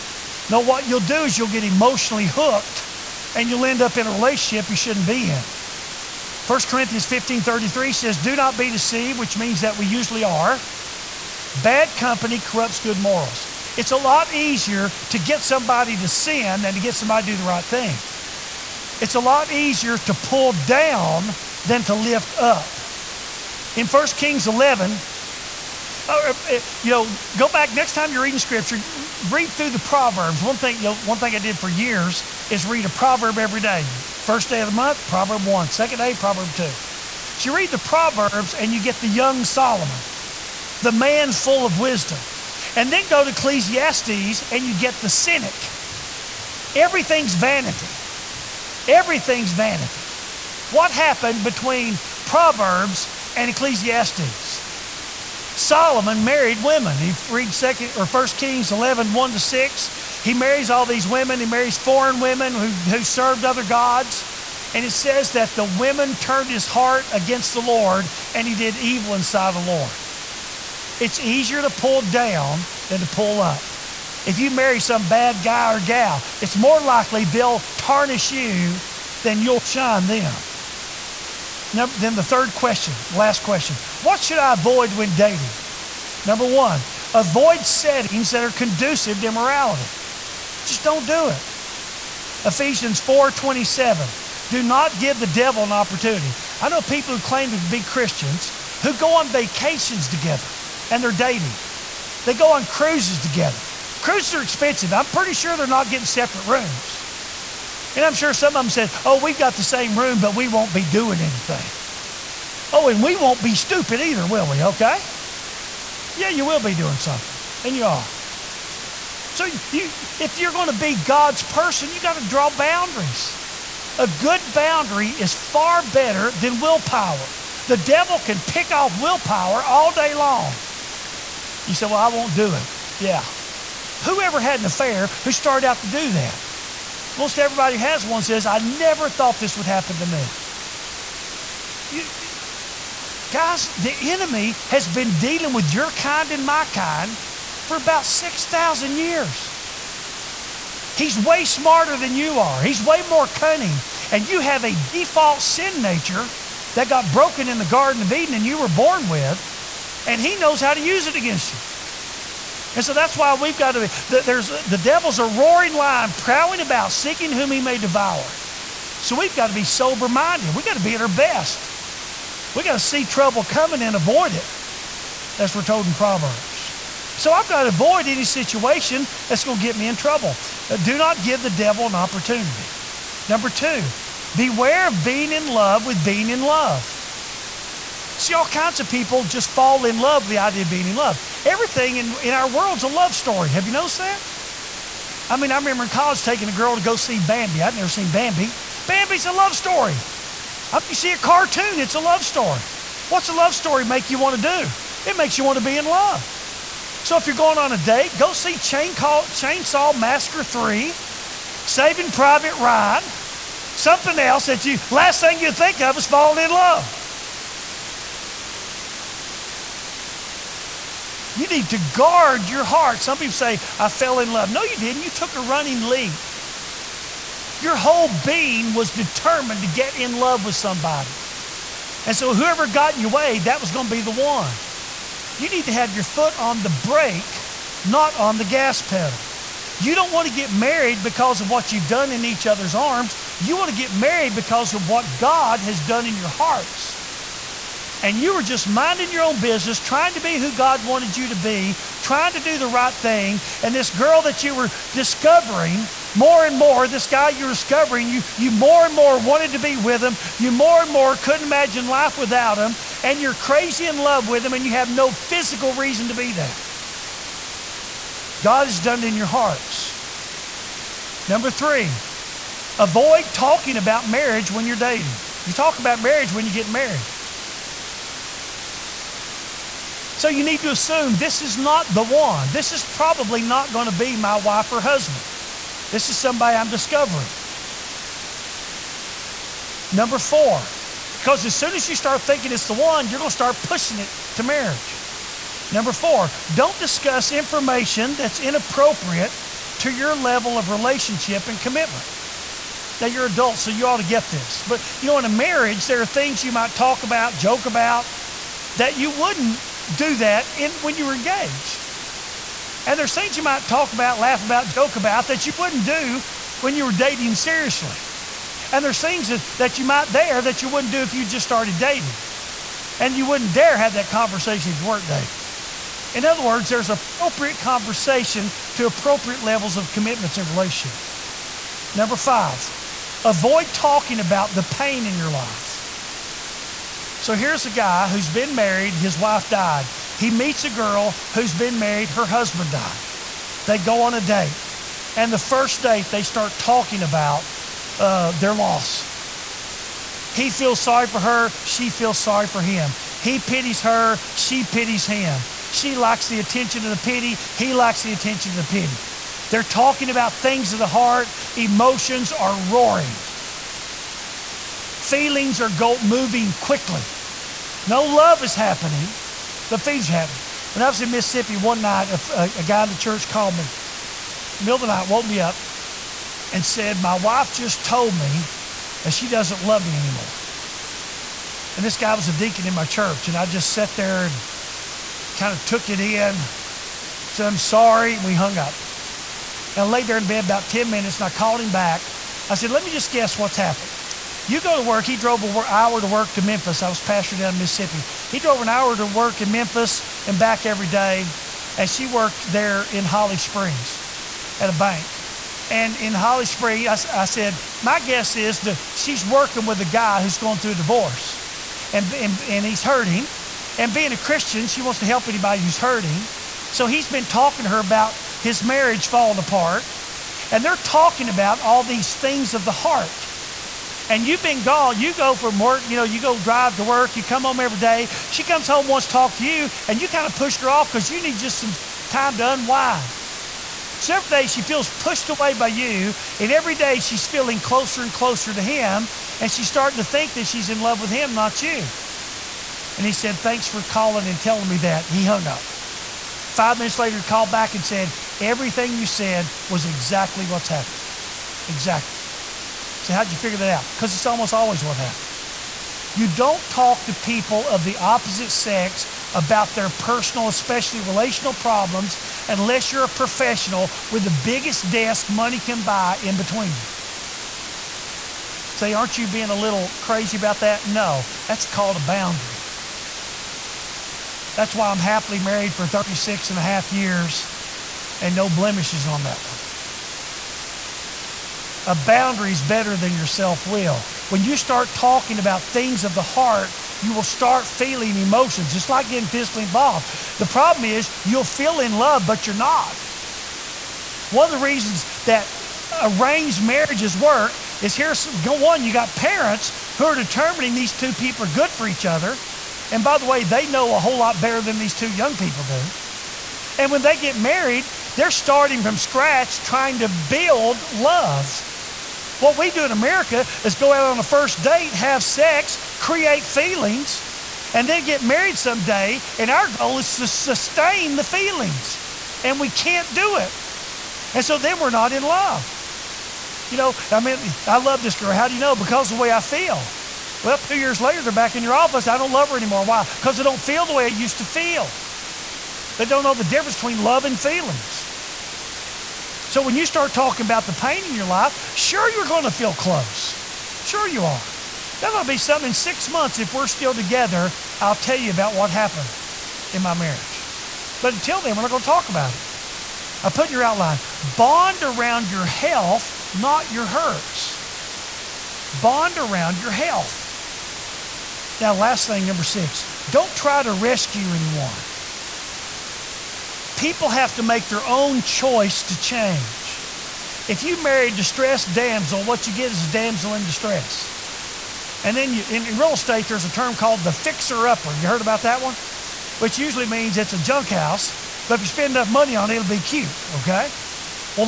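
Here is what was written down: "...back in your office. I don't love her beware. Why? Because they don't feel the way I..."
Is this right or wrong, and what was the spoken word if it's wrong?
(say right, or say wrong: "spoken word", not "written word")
wrong: "anymore", not "beware".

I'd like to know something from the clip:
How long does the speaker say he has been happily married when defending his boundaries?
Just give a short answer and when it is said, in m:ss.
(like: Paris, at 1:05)
36 and a half years, at 7:55.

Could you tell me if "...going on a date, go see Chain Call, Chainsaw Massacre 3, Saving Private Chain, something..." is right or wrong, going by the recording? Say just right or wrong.
wrong.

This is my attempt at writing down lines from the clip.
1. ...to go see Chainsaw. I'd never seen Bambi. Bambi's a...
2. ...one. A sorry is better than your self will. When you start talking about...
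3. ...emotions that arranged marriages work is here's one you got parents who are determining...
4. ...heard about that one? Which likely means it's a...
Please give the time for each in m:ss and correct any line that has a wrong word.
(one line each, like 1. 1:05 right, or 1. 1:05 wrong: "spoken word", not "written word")
1. 3:16 wrong: "Bambi", not "Chainsaw"
2. 7:59 wrong: "boundary", not "sorry"
3. 8:14 wrong: "reasons", not "emotions"
4. 9:38 wrong: "usually", not "likely".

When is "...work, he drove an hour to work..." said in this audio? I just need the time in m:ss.
6:34.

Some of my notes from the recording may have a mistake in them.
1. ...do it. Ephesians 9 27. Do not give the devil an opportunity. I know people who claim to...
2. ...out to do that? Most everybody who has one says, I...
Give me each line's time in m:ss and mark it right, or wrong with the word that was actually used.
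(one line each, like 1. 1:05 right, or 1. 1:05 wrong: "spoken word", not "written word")
1. 1:31 wrong: "4", not "9"
2. 2:15 right.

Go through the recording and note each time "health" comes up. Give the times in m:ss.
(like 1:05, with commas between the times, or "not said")
9:15, 9:19.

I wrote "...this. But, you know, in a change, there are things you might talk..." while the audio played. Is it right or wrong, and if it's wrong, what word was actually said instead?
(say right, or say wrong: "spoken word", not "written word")
wrong: "marriage", not "change".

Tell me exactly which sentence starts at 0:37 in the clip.
So you read the Proverbs and you get the young Solomon, the man full of wisdom.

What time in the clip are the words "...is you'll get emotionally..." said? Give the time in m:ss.
0:01.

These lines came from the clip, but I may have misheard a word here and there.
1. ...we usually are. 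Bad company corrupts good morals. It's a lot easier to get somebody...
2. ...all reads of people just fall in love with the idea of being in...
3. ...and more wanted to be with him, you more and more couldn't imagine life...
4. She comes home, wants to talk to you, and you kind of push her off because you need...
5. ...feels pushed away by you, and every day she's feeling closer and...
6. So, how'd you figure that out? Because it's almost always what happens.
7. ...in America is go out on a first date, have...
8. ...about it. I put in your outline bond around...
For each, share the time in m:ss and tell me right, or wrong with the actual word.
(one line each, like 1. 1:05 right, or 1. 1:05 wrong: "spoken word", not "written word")
1. 0:09 right
2. 3:08 wrong: "kinds", not "reads"
3. 4:18 right
4. 7:08 right
5. 7:14 right
6. 7:32 right
7. 8:32 right
8. 9:12 right.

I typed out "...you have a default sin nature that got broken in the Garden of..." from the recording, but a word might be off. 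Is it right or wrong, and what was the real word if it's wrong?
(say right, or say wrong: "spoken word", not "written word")
right.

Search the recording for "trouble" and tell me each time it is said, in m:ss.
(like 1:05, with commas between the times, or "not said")
2:53, 2:59.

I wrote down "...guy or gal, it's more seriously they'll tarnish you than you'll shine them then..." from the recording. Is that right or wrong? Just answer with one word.
wrong.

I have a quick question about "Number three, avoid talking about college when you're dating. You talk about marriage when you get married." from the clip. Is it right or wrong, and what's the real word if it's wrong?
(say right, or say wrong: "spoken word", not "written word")
wrong: "marriage", not "college".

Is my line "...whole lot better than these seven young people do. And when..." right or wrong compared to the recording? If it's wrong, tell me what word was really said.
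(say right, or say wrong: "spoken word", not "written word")
wrong: "two", not "seven".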